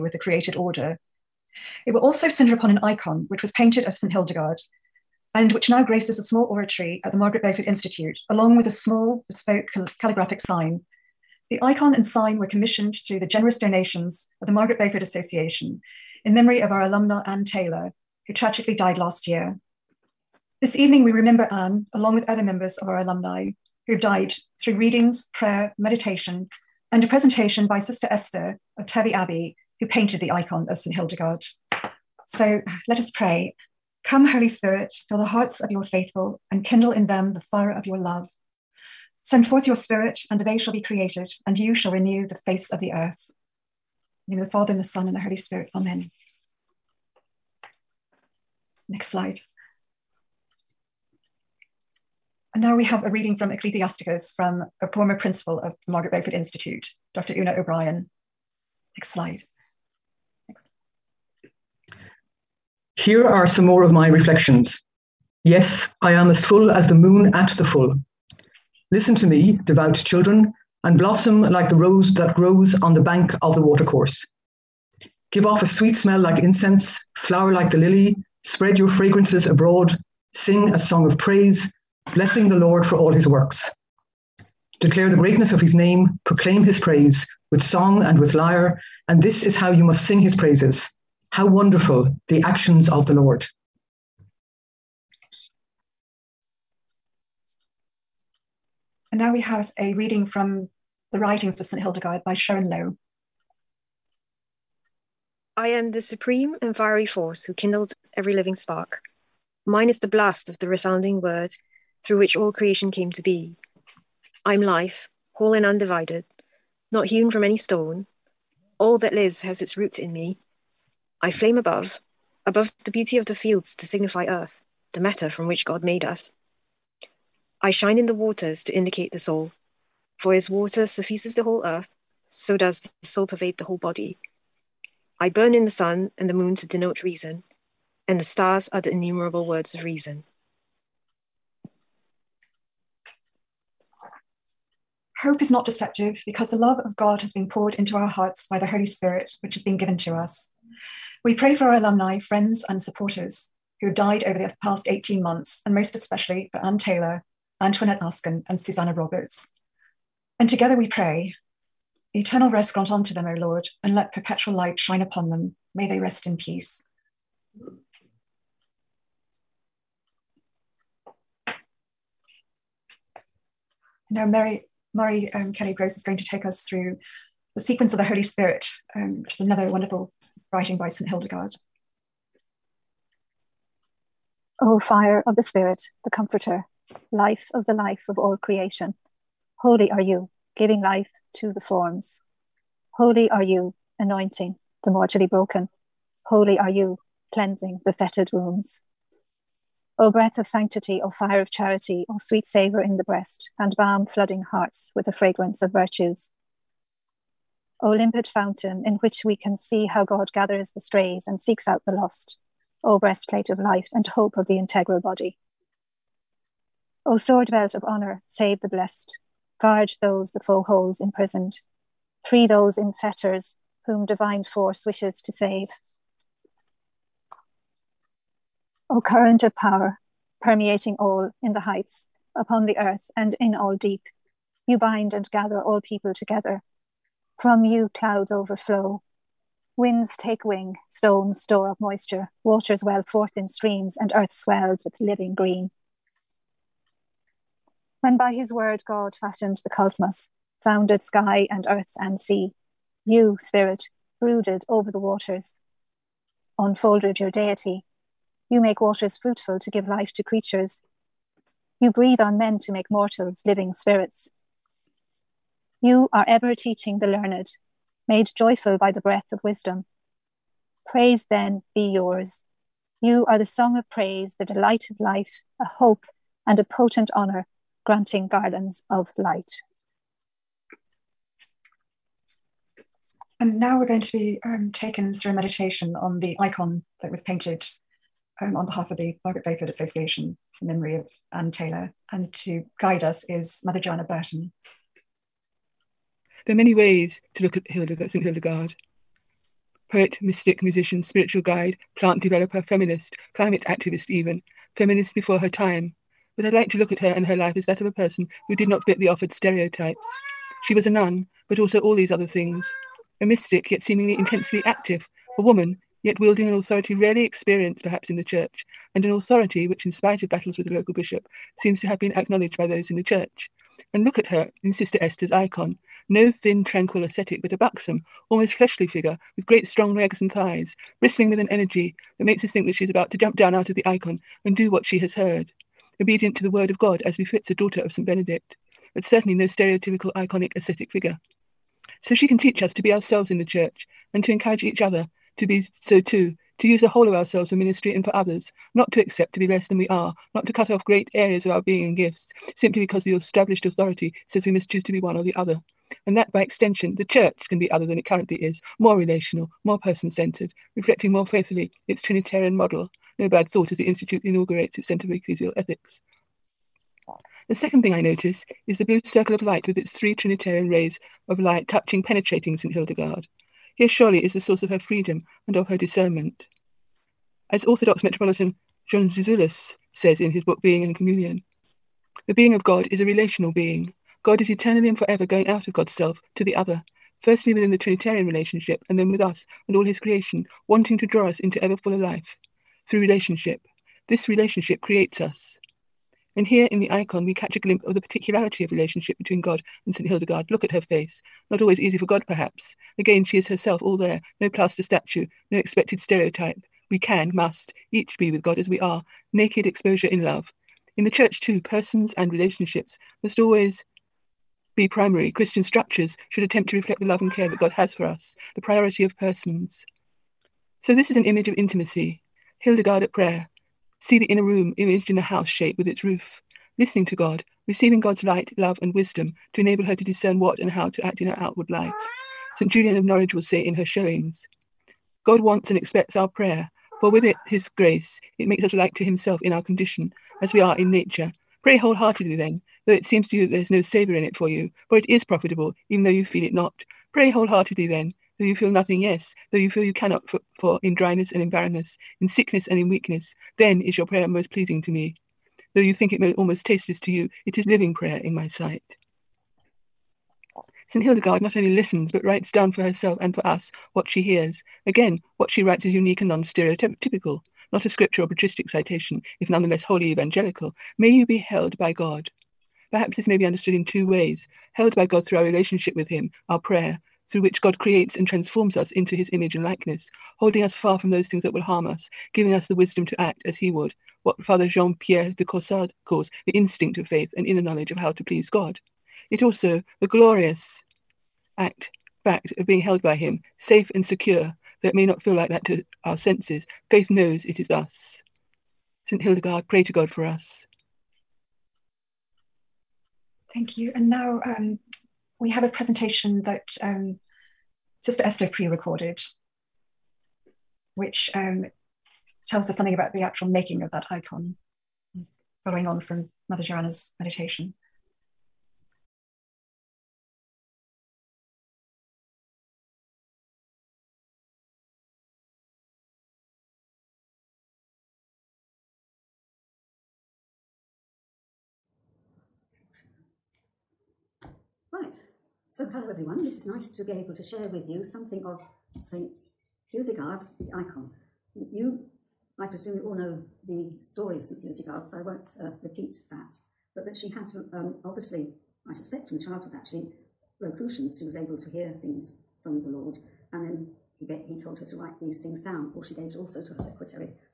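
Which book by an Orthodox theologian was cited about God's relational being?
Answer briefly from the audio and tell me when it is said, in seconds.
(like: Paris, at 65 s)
Being and Communion, at 380 s.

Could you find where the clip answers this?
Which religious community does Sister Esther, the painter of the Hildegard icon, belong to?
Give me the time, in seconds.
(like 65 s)
28 s.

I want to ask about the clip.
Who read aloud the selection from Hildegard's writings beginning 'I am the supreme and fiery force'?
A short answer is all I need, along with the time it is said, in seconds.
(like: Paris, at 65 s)
Sharon Lowe, at 102 s.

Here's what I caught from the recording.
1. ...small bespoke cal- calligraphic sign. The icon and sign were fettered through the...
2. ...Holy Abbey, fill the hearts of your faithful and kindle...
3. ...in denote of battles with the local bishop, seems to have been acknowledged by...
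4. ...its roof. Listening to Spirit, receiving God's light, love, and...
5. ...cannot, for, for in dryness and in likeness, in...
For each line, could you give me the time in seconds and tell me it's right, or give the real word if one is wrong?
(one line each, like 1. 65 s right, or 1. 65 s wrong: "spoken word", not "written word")
1. 8 s wrong: "commissioned", not "fettered"
2. 34 s wrong: "Spirit", not "Abbey"
3. 319 s wrong: "spite", not "denote"
4. 425 s wrong: "God", not "Spirit"
5. 449 s wrong: "barrenness", not "likeness".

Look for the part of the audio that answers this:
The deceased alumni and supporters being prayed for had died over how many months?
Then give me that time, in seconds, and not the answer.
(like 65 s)
154 s.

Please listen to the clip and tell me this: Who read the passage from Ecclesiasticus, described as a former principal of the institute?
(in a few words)
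Dr. Una O'Brien.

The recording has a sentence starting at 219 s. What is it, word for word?
Guard those the foe holds imprisoned.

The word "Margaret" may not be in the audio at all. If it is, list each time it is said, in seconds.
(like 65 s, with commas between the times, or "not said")
7 s, 14 s, 55 s, 289 s.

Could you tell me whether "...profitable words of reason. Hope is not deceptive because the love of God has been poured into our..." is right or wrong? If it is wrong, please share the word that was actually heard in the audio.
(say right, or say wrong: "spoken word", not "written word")
wrong: "innumerable", not "profitable".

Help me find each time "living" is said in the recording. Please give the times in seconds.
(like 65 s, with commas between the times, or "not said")
108 s, 244 s, 263 s, 457 s.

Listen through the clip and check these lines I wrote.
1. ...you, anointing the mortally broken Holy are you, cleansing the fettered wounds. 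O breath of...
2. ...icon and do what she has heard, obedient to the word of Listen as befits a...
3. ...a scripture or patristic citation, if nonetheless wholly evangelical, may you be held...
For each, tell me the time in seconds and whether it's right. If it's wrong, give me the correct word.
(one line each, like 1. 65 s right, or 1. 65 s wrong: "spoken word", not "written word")
1. 193 s right
2. 333 s wrong: "God", not "Listen"
3. 467 s right.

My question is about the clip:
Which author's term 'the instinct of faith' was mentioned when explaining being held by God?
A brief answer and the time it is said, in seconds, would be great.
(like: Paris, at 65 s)
Jean Pierre de Caussade, at 484 s.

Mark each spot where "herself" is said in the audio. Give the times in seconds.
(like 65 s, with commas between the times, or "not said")
403 s, 462 s.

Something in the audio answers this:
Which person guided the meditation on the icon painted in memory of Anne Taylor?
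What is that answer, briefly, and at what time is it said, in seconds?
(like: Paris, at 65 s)
Mother Joanna Burton, at 293 s.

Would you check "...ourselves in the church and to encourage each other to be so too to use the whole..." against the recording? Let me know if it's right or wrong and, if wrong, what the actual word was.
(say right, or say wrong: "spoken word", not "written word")
right.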